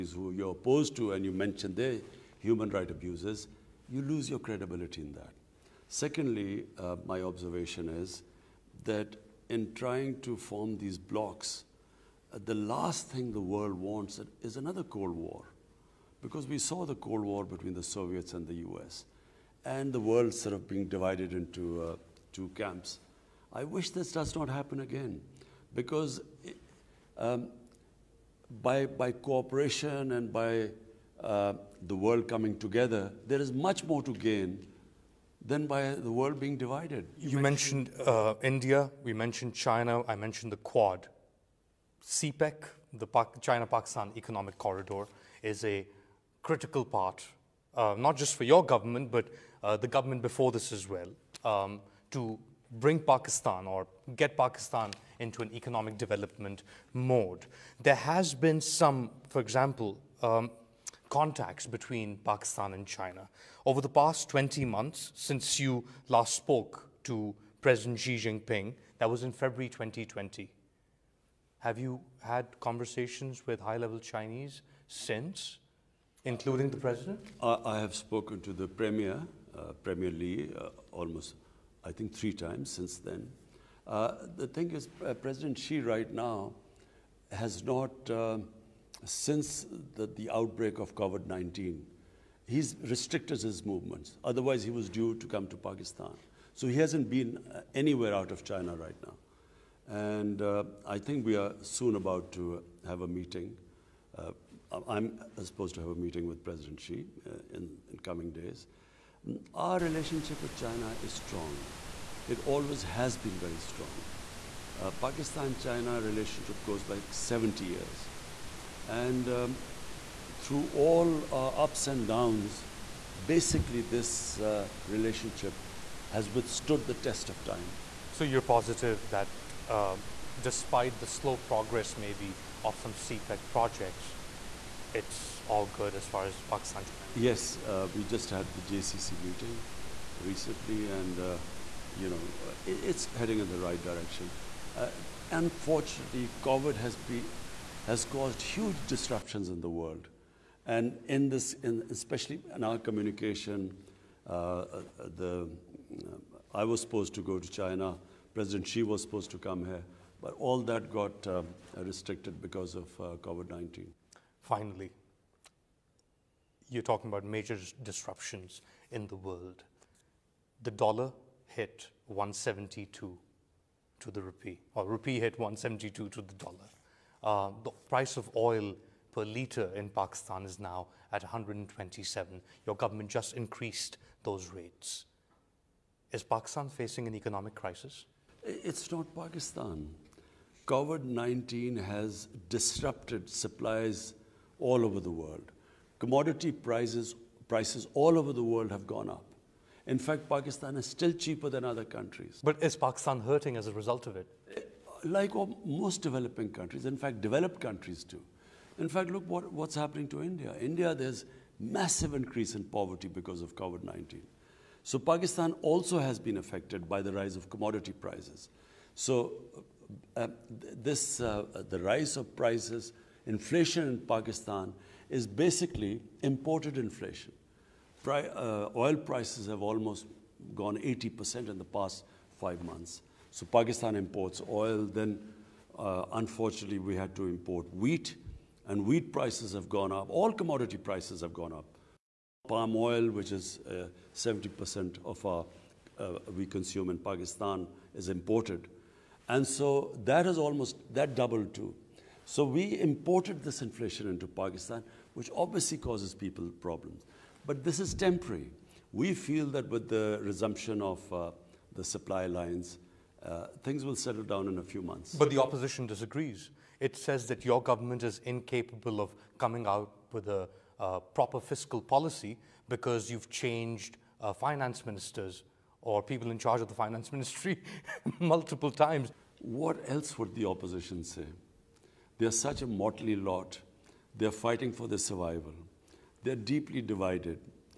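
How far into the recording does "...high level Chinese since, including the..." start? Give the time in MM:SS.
01:13.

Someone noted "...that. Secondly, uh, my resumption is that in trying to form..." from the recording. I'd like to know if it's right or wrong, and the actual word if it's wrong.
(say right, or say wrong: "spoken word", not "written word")
wrong: "observation", not "resumption".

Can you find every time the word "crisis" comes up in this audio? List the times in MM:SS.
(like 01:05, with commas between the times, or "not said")
03:07.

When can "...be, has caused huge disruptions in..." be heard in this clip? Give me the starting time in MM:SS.
02:26.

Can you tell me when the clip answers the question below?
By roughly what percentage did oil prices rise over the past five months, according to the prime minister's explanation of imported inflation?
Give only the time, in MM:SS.
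03:50.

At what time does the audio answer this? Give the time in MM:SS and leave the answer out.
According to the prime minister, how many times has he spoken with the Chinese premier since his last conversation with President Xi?
01:22.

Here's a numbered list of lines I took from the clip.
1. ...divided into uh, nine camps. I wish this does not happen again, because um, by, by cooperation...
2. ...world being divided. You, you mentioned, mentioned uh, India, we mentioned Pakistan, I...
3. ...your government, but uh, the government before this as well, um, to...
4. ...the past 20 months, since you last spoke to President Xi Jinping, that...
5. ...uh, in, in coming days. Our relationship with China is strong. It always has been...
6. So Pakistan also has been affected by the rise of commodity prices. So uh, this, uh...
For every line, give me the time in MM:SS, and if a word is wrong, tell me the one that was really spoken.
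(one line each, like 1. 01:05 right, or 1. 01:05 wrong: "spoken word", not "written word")
1. 00:20 wrong: "two", not "nine"
2. 00:36 wrong: "China", not "Pakistan"
3. 00:48 right
4. 01:03 right
5. 01:47 right
6. 03:34 right.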